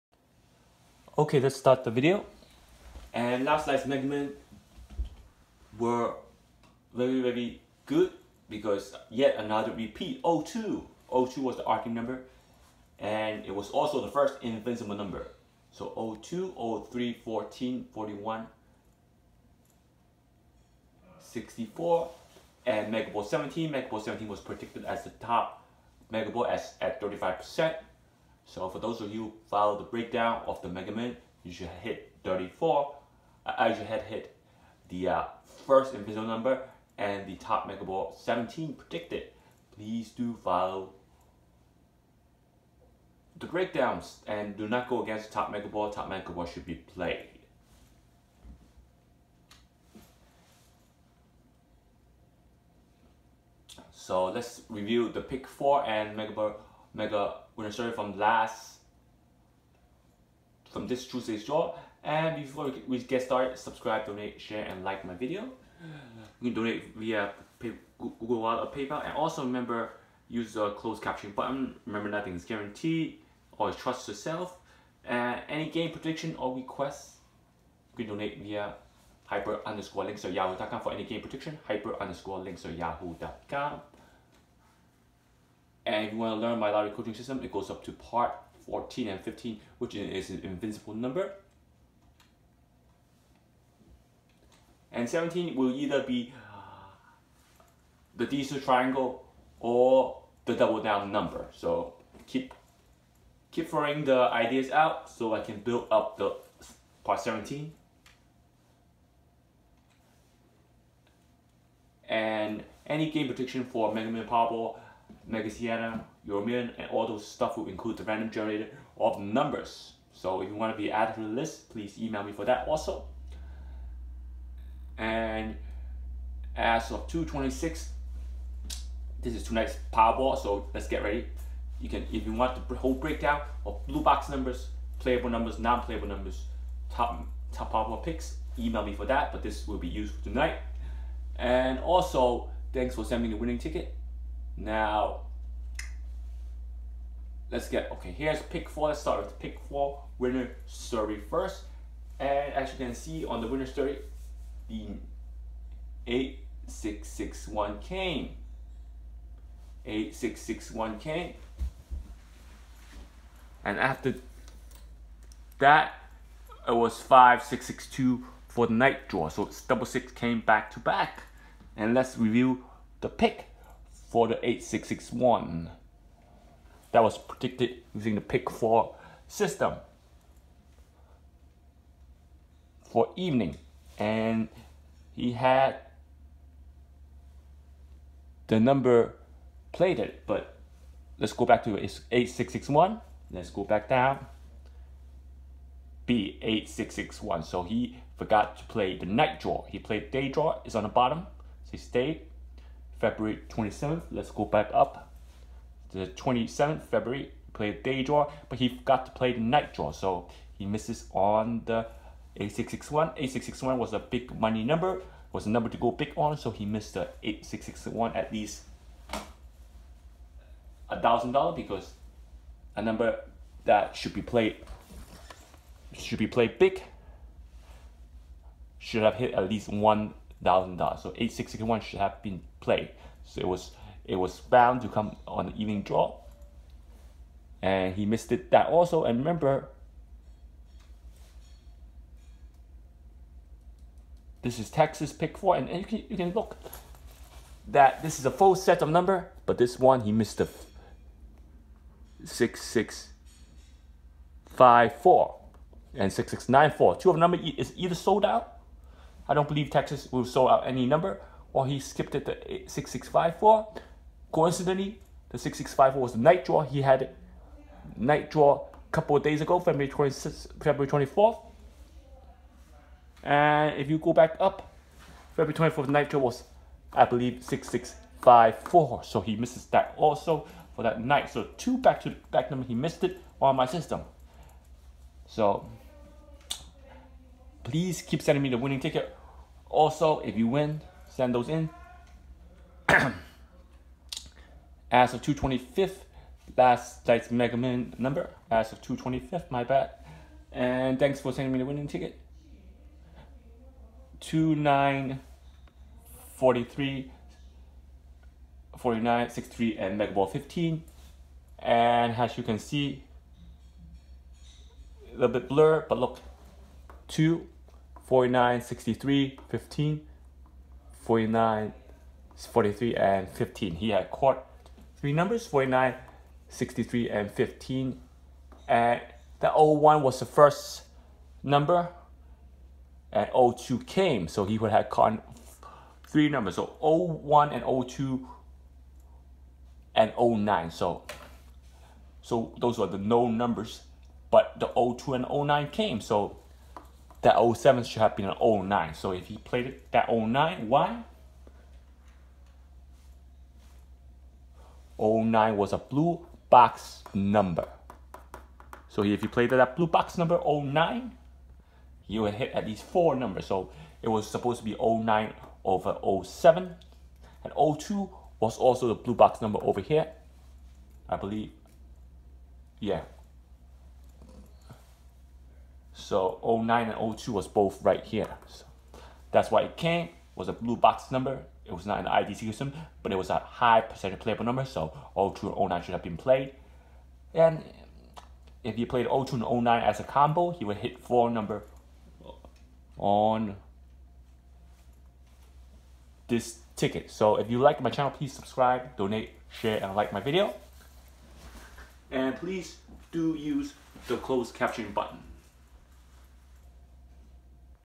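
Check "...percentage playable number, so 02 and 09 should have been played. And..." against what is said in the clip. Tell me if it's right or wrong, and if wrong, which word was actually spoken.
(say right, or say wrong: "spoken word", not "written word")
right.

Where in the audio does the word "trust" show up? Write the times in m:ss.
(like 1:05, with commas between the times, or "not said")
1:13.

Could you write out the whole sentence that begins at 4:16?
Two of number is either sold out I don't believe Texas will sell out any number, or he skipped it to 6654.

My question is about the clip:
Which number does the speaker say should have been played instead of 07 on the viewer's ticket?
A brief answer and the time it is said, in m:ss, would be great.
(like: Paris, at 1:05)
09, at 6:04.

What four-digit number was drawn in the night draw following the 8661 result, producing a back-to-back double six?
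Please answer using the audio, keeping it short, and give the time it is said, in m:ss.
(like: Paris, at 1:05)
5662, at 2:47.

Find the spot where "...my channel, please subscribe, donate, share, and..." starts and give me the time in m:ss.
6:37.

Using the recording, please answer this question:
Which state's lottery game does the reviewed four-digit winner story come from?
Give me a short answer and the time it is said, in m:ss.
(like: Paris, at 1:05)
Texas pick four, at 4:04.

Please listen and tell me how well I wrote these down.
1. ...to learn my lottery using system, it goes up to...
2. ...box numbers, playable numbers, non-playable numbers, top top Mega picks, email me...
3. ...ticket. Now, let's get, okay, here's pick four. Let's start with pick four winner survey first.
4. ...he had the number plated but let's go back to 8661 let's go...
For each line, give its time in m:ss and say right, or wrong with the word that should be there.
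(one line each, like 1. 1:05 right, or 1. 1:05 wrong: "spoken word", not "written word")
1. 1:26 wrong: "coaching", not "using"
2. 2:14 wrong: "Powerball", not "Mega"
3. 2:23 right
4. 3:05 right.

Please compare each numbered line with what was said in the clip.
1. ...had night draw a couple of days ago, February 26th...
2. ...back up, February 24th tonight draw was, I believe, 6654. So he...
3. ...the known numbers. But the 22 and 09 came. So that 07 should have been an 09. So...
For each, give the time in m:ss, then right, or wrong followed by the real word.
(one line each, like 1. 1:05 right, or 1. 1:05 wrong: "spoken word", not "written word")
1. 4:26 right
2. 4:34 wrong: "night", not "tonight"
3. 5:42 wrong: "02", not "22".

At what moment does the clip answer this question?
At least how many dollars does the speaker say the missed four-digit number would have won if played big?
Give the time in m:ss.
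3:49.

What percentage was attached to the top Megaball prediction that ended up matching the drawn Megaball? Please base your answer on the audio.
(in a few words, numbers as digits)
35%.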